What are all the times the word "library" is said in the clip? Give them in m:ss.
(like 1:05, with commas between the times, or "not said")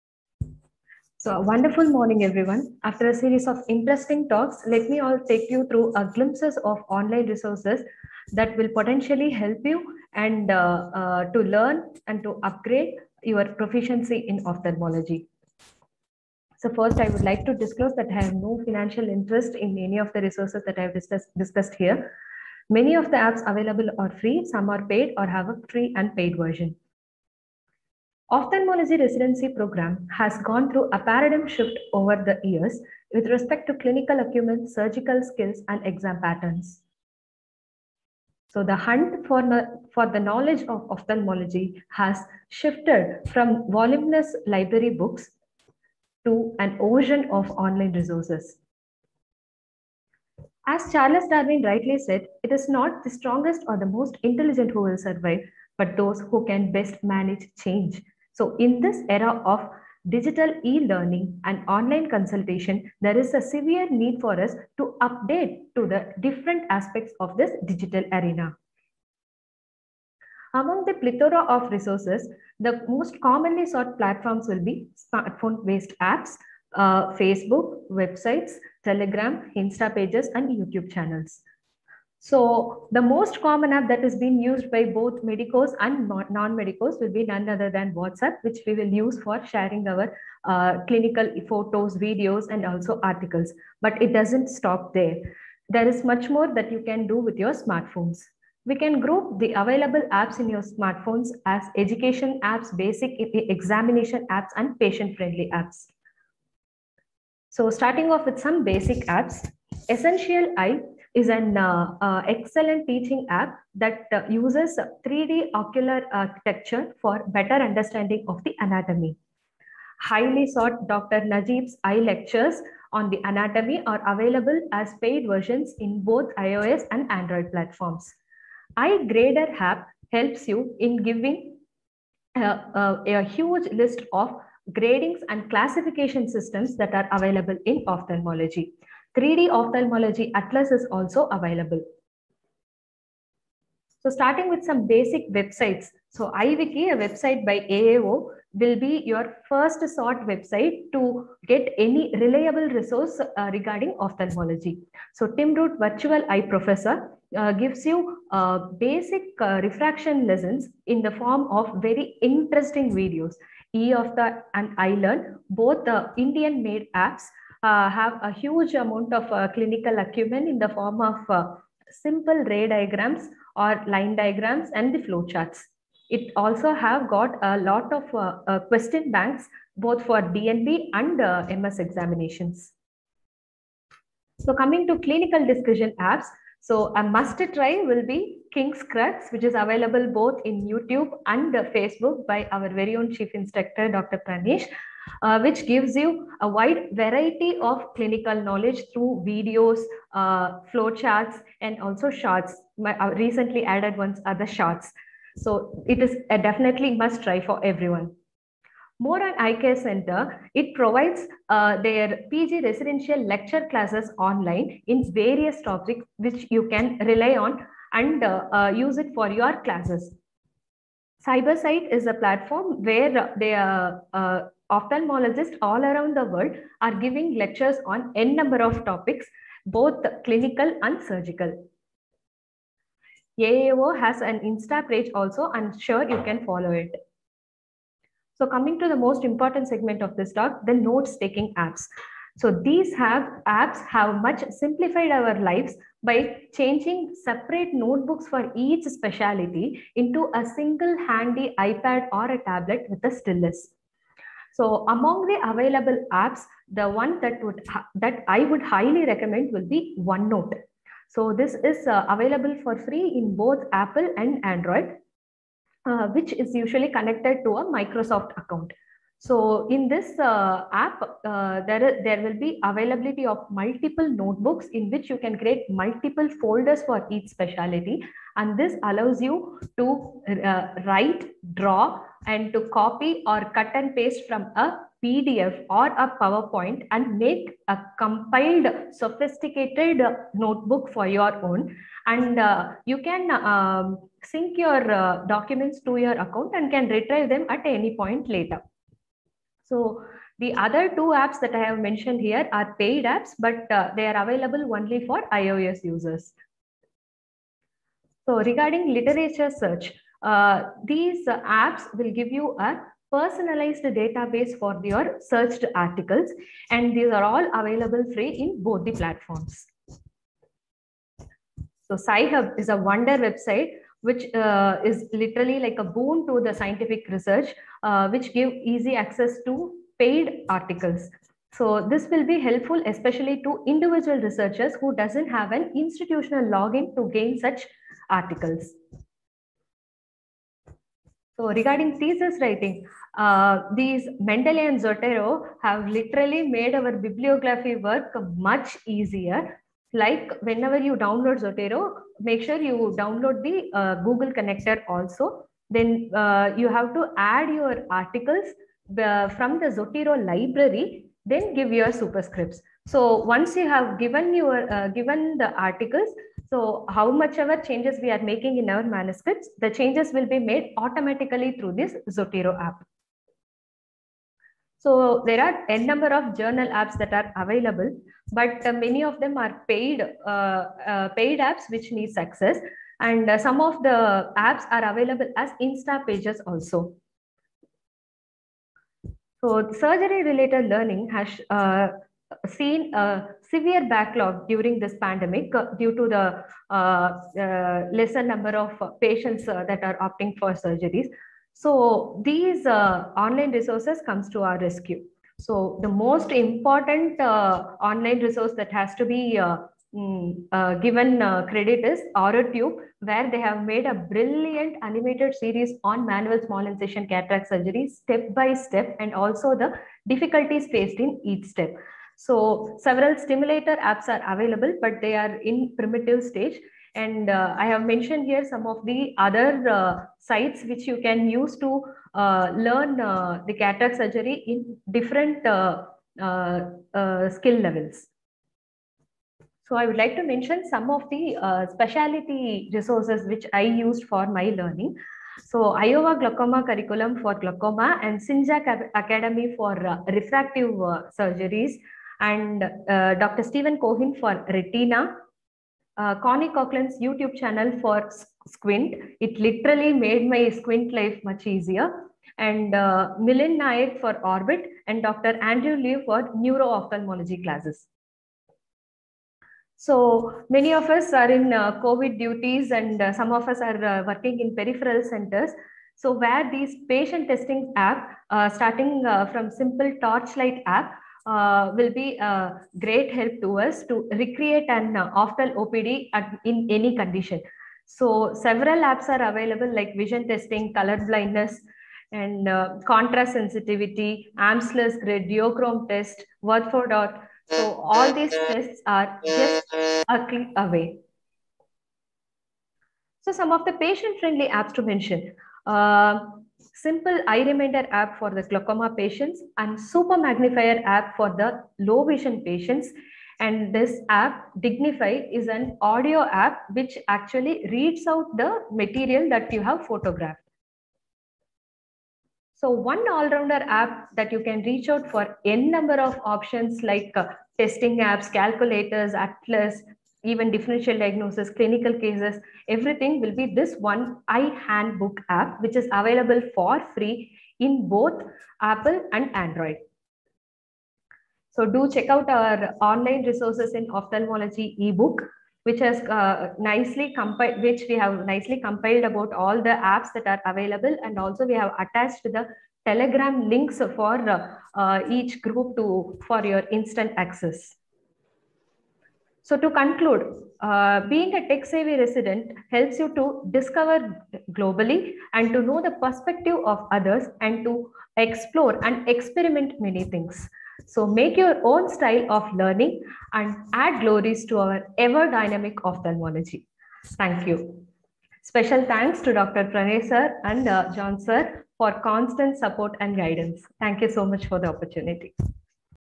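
0:44, 6:00.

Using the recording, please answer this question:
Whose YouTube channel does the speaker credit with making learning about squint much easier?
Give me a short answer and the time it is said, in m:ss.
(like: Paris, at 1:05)
Connie Coughlin, at 7:36.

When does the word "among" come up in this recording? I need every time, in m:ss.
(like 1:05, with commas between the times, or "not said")
1:10, 4:14.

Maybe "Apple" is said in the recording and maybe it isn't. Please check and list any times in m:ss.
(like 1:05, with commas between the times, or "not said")
4:23, 8:58.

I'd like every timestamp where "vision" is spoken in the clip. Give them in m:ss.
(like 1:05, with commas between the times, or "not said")
8:09, 8:32.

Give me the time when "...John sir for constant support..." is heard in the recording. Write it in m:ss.
9:40.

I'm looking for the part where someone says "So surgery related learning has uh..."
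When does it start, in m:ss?
6:29.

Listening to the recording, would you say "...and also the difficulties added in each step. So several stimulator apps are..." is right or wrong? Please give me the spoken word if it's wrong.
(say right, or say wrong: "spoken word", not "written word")
wrong: "faced", not "added".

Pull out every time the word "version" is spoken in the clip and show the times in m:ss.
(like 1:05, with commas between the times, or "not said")
0:26, 2:05.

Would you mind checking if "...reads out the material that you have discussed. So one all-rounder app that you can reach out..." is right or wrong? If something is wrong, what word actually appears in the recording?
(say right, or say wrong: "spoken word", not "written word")
wrong: "photographed", not "discussed".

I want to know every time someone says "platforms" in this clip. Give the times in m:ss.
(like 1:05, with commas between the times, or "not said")
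1:13, 2:07, 3:42, 5:18.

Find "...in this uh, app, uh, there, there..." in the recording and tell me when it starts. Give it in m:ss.
4:29.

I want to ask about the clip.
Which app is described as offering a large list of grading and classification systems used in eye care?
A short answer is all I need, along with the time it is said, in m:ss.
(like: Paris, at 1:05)
iGrader, at 2:08.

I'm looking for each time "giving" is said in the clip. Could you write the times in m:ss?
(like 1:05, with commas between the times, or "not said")
2:11, 3:47.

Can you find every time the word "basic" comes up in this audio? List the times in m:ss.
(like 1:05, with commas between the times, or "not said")
1:42, 1:48, 2:24, 2:38.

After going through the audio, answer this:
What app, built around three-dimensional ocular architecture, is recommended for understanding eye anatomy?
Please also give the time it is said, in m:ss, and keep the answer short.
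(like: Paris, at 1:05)
Essential Eye, at 1:49.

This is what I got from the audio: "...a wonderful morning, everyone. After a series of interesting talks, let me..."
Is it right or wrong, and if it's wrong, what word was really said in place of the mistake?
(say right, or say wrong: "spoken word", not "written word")
right.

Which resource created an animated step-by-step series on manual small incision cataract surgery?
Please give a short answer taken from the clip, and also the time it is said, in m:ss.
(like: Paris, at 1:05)
AuraTube, at 6:52.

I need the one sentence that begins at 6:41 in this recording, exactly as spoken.
So these online resources comes to our rescue.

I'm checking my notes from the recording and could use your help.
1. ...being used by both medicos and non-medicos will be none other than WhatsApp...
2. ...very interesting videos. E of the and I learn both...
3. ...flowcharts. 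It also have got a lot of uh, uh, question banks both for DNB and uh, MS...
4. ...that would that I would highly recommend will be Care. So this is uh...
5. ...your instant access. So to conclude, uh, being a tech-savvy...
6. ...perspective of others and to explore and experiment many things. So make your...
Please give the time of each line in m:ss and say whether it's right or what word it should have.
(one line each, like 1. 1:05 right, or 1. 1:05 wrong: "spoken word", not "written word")
1. 1:24 right
2. 2:41 right
3. 2:55 right
4. 4:17 wrong: "OneNote", not "Care"
5. 9:16 right
6. 9:25 right.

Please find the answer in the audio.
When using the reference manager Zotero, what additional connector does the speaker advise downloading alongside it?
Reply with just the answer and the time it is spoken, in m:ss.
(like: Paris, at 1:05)
Google connector, at 5:53.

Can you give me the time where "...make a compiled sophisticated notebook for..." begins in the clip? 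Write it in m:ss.
4:47.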